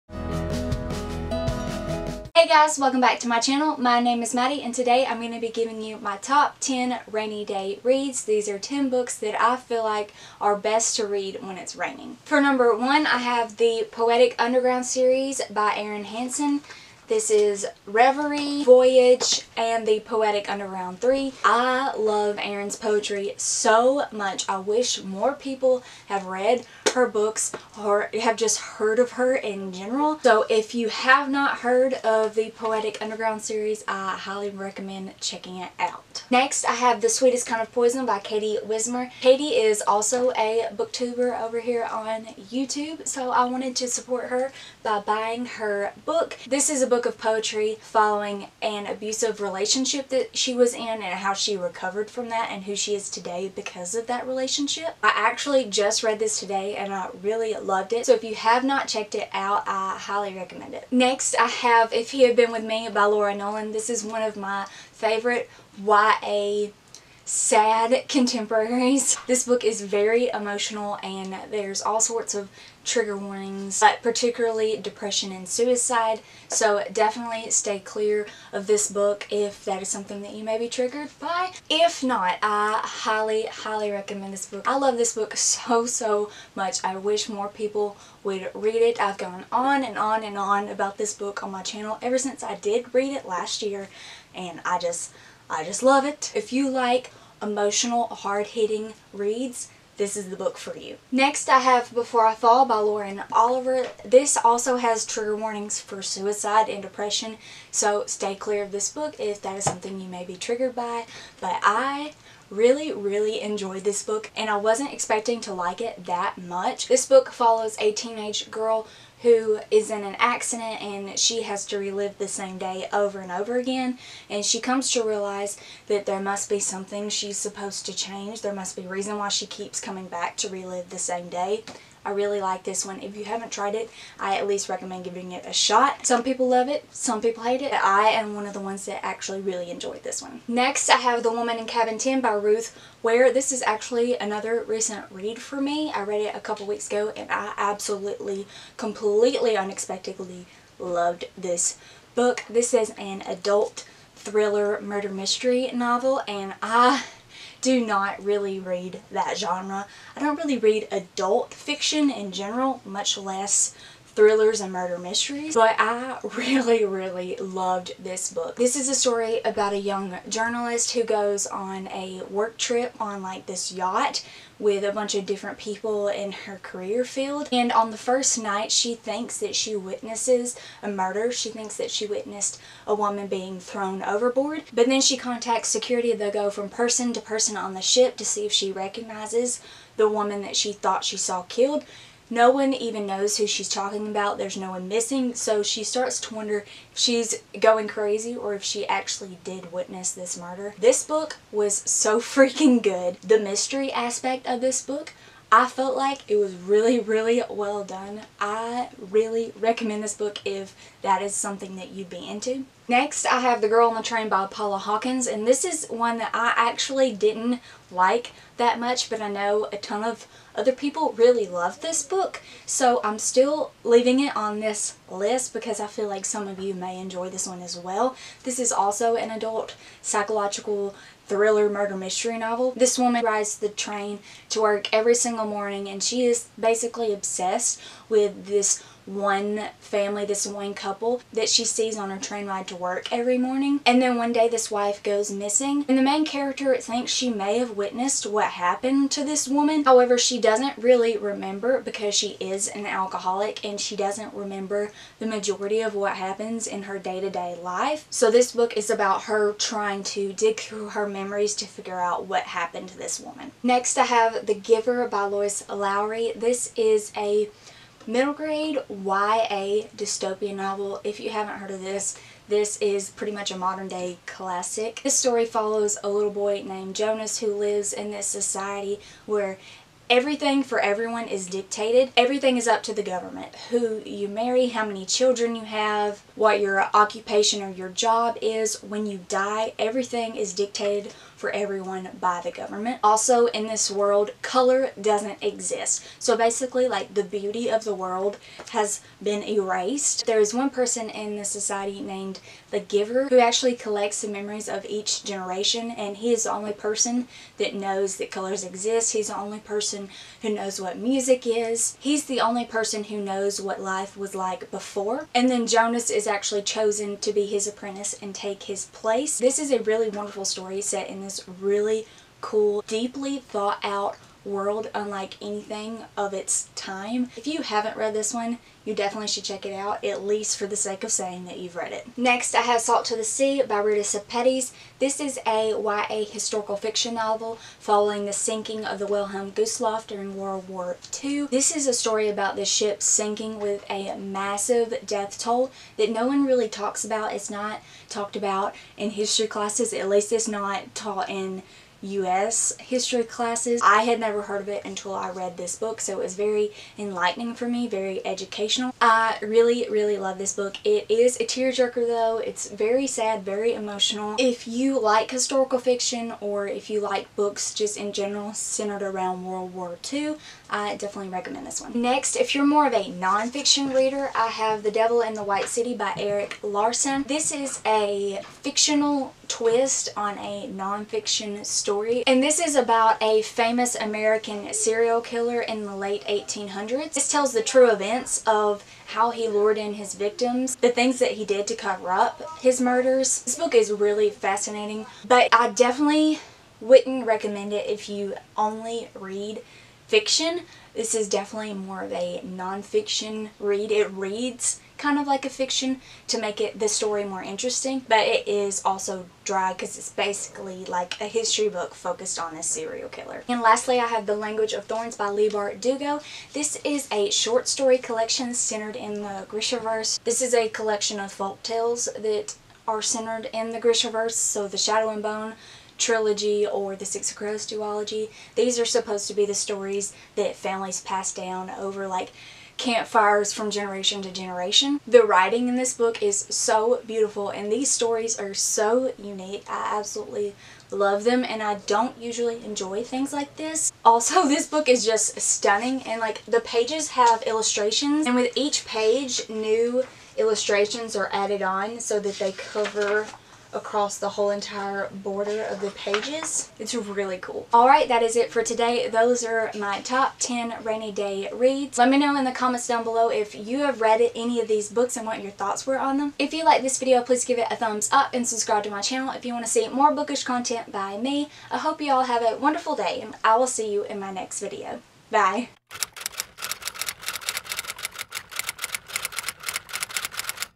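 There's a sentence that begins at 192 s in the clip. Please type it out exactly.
No one even knows who she's talking about.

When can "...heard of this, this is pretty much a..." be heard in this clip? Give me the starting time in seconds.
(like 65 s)
271 s.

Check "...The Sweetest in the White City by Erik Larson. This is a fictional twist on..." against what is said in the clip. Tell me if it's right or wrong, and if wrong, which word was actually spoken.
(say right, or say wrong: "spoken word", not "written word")
wrong: "Devil", not "Sweetest".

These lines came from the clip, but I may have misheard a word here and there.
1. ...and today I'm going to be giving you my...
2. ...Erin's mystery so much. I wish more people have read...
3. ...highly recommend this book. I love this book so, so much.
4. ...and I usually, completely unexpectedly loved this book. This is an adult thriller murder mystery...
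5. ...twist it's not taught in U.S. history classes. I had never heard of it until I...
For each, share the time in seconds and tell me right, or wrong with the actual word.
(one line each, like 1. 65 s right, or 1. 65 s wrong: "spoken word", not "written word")
1. 4 s right
2. 22 s wrong: "poetry", not "mystery"
3. 83 s right
4. 147 s wrong: "absolutely", not "usually"
5. 350 s wrong: "least", not "twist".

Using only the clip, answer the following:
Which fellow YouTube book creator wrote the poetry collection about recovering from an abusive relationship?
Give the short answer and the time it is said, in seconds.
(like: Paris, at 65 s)
Katie Wismer, at 38 s.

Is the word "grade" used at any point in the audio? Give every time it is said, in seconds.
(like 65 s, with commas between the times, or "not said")
268 s.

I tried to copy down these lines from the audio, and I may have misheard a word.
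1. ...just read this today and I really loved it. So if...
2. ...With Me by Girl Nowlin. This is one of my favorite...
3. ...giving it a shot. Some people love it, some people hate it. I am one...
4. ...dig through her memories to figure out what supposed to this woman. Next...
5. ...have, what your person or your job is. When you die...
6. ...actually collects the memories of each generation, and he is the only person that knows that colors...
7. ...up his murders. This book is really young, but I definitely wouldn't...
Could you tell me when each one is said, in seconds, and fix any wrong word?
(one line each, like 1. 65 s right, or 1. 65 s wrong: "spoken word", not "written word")
1. 55 s right
2. 62 s wrong: "Laura", not "Girl"
3. 135 s right
4. 260 s wrong: "happened", not "supposed"
5. 285 s wrong: "occupation", not "person"
6. 303 s right
7. 392 s wrong: "fascinating", not "young".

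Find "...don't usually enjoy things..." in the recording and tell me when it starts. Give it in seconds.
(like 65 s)
441 s.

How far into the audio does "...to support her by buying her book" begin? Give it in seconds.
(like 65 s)
43 s.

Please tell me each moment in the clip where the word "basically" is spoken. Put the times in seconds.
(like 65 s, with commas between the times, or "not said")
236 s, 296 s, 410 s.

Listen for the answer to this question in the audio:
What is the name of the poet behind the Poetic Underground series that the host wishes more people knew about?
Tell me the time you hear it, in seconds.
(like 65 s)
15 s.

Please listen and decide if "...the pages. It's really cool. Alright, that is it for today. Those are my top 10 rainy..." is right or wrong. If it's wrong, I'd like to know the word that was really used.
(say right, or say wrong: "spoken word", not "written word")
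right.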